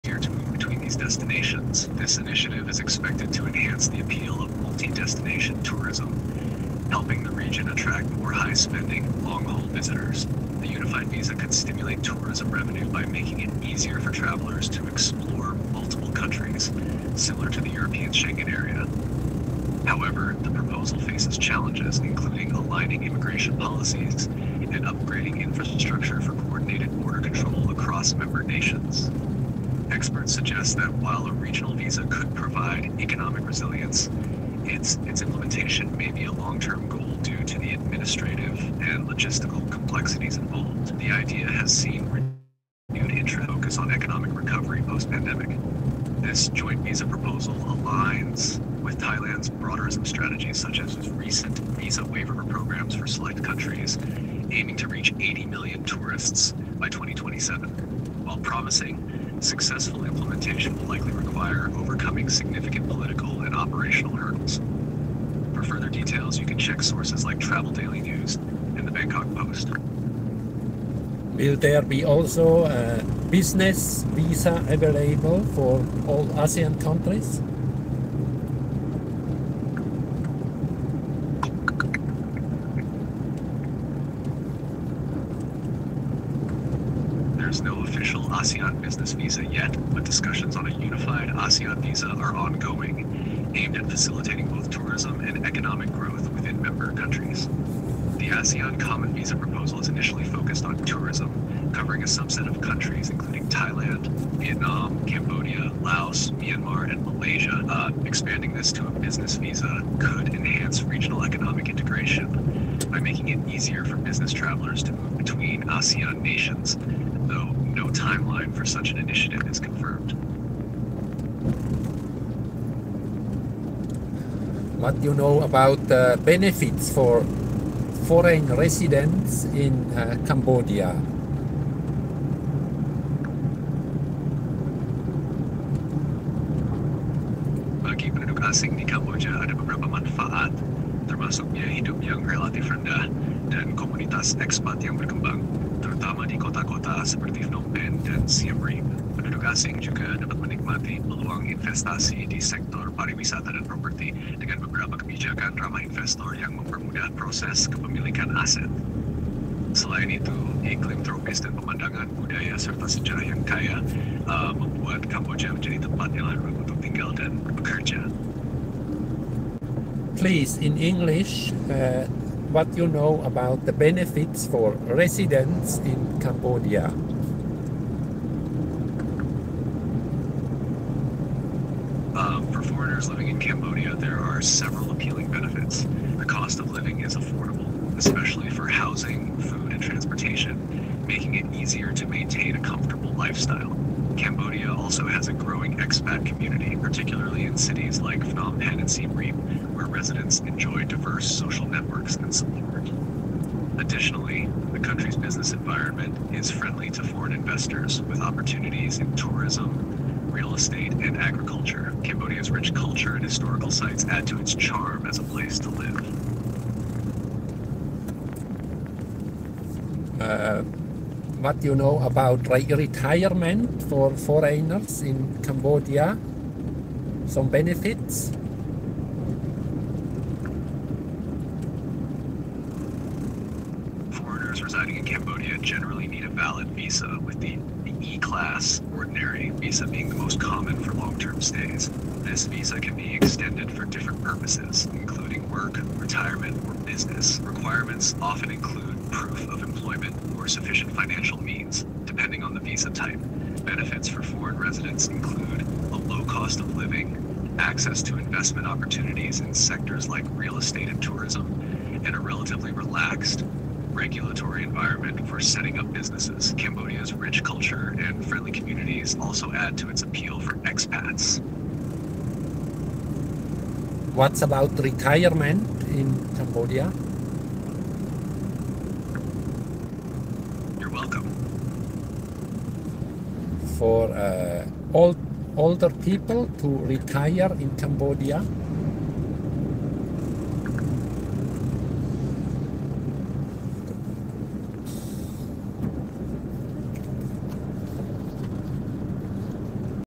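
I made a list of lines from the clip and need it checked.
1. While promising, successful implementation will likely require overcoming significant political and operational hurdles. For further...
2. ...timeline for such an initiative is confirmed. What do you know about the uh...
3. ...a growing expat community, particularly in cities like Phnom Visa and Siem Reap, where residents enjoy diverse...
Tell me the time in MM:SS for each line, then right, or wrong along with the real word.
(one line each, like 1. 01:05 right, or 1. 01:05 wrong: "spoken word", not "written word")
1. 00:58 right
2. 01:57 right
3. 03:15 wrong: "Penh", not "Visa".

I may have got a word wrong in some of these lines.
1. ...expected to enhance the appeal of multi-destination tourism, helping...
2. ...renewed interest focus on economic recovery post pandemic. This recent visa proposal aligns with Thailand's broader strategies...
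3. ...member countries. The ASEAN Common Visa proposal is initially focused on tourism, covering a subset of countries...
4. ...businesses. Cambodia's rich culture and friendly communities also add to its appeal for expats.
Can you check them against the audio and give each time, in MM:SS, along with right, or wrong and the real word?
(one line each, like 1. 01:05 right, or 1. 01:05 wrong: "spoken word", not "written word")
1. 00:02 right
2. 00:42 wrong: "joint", not "recent"
3. 01:36 right
4. 04:25 right.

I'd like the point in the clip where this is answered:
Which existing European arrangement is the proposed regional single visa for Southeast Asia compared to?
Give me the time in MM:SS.
00:18.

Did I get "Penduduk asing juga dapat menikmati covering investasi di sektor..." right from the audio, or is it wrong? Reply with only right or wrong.
wrong.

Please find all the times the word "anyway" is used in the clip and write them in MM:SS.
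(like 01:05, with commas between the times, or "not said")
not said.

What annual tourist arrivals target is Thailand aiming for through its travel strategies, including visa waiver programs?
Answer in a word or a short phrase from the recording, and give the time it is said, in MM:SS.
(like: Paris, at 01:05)
80 million by 2027, at 00:55.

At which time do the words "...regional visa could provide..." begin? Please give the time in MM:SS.
00:31.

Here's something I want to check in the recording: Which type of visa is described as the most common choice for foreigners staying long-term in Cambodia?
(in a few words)
E-class ordinary visa.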